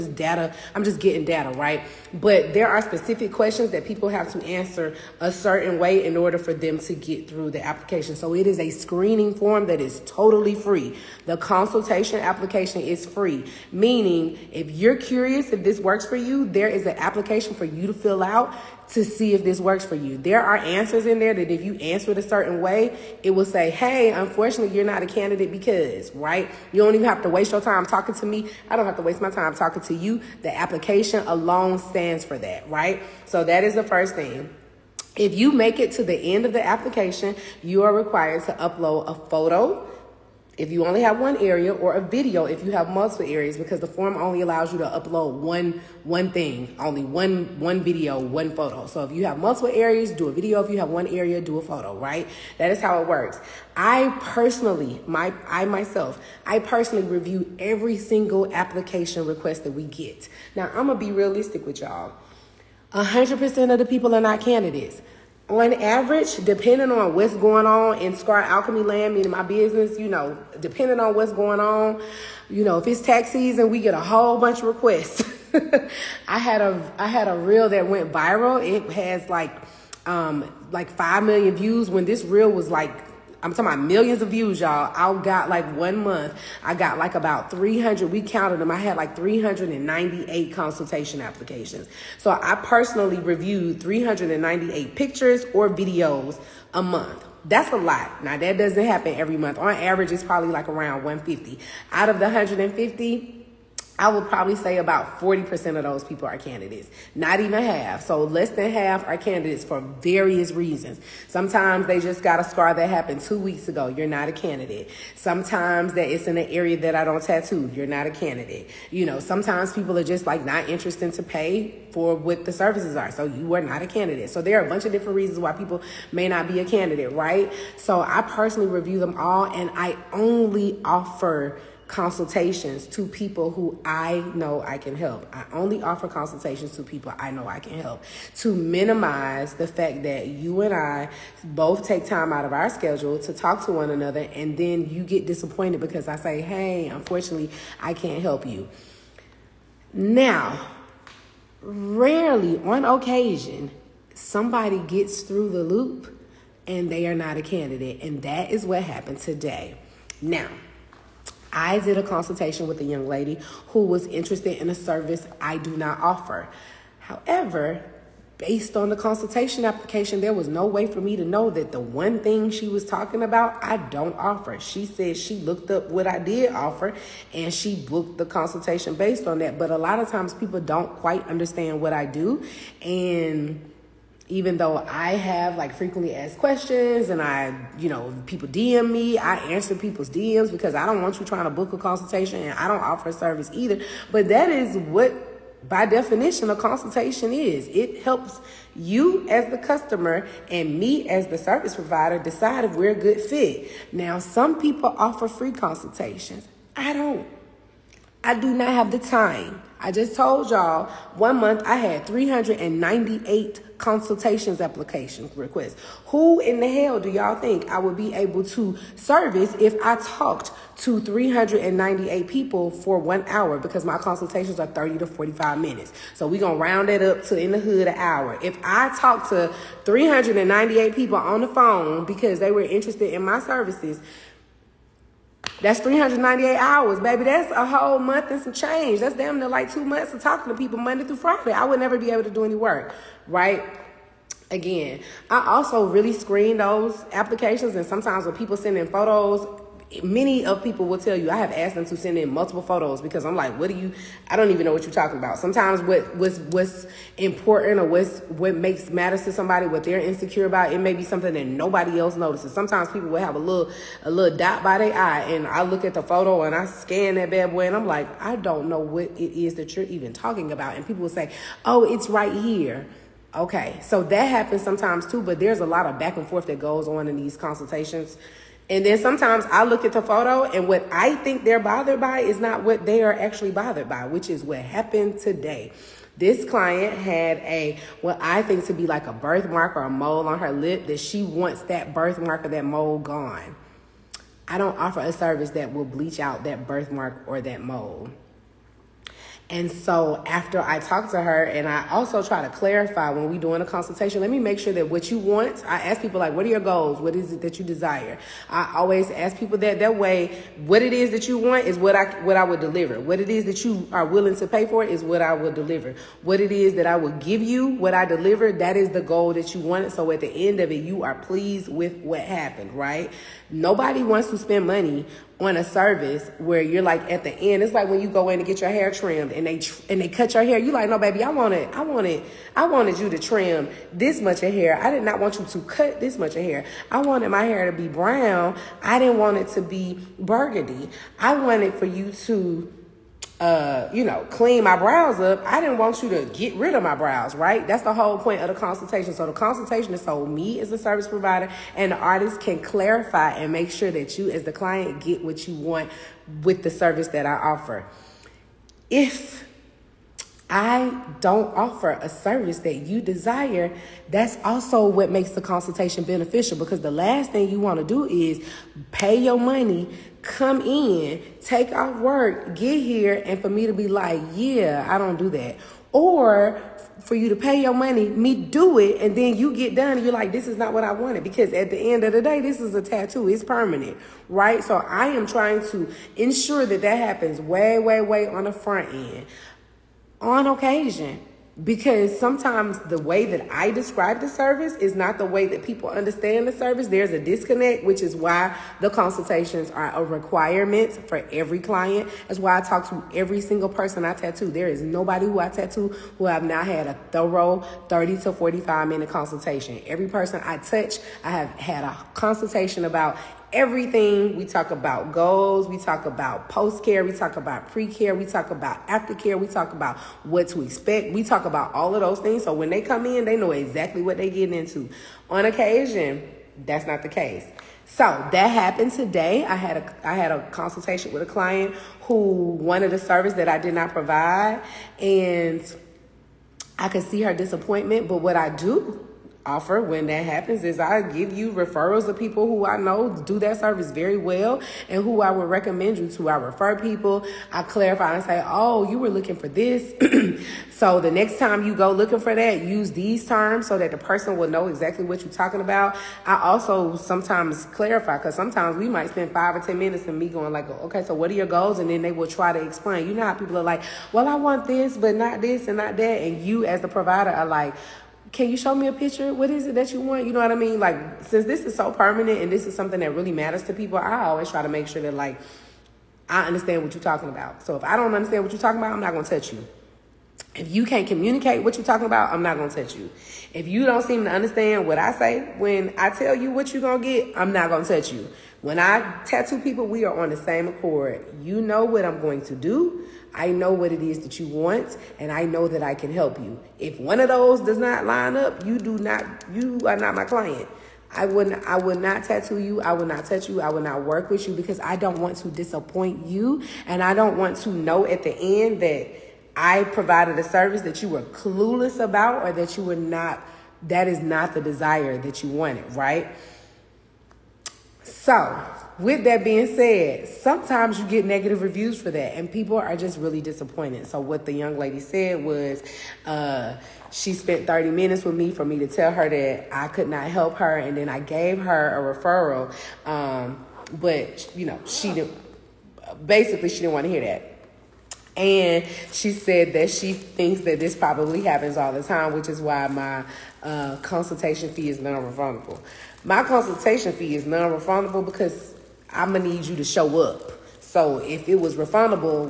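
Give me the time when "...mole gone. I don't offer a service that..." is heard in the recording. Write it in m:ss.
4:52.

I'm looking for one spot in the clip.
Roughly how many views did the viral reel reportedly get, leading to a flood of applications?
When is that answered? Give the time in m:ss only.
1:20.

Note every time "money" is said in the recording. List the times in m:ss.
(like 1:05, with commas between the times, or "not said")
5:24, 6:09, 6:17.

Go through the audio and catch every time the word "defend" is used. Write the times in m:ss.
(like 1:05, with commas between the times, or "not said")
not said.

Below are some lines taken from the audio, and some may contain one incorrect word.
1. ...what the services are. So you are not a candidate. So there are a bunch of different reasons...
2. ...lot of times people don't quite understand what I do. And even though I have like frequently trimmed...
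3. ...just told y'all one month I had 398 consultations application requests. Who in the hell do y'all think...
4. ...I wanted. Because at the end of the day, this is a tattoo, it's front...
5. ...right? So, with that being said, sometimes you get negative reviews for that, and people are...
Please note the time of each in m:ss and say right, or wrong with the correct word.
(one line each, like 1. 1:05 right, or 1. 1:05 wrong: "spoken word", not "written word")
1. 2:02 right
2. 2:59 wrong: "asked", not "trimmed"
3. 3:29 right
4. 6:20 wrong: "permanent", not "front"
5. 8:35 right.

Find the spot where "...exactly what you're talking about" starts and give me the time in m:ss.
7:34.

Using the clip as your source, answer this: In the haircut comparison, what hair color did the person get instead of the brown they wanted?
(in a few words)
Burgundy.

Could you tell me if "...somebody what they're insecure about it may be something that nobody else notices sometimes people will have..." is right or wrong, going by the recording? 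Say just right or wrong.
right.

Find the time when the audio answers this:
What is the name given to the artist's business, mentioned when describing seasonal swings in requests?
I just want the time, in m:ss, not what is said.
1:08.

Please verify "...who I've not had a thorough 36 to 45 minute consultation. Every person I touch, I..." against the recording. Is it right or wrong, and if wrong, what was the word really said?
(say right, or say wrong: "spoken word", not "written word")
wrong: "30", not "36".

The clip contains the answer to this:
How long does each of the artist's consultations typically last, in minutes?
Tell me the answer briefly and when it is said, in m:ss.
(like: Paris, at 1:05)
30 to 45 minutes, at 3:44.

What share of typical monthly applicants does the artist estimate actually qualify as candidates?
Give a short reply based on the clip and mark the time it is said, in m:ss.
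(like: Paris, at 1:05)
40%, at 1:45.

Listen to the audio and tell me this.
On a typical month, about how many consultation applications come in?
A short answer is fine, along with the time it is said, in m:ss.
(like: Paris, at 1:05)
150, at 1:40.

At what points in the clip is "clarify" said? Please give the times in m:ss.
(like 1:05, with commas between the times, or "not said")
5:02, 5:52, 7:27, 7:37.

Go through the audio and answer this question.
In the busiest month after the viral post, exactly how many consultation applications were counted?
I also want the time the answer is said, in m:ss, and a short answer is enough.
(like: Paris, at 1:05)
398, at 1:29.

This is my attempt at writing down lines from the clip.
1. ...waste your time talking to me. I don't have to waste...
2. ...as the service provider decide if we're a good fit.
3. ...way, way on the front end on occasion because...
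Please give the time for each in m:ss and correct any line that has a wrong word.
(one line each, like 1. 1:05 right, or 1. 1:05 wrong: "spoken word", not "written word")
1. 0:27 right
2. 3:21 right
3. 6:27 right.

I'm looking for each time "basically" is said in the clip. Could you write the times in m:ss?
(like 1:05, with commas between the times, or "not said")
8:56.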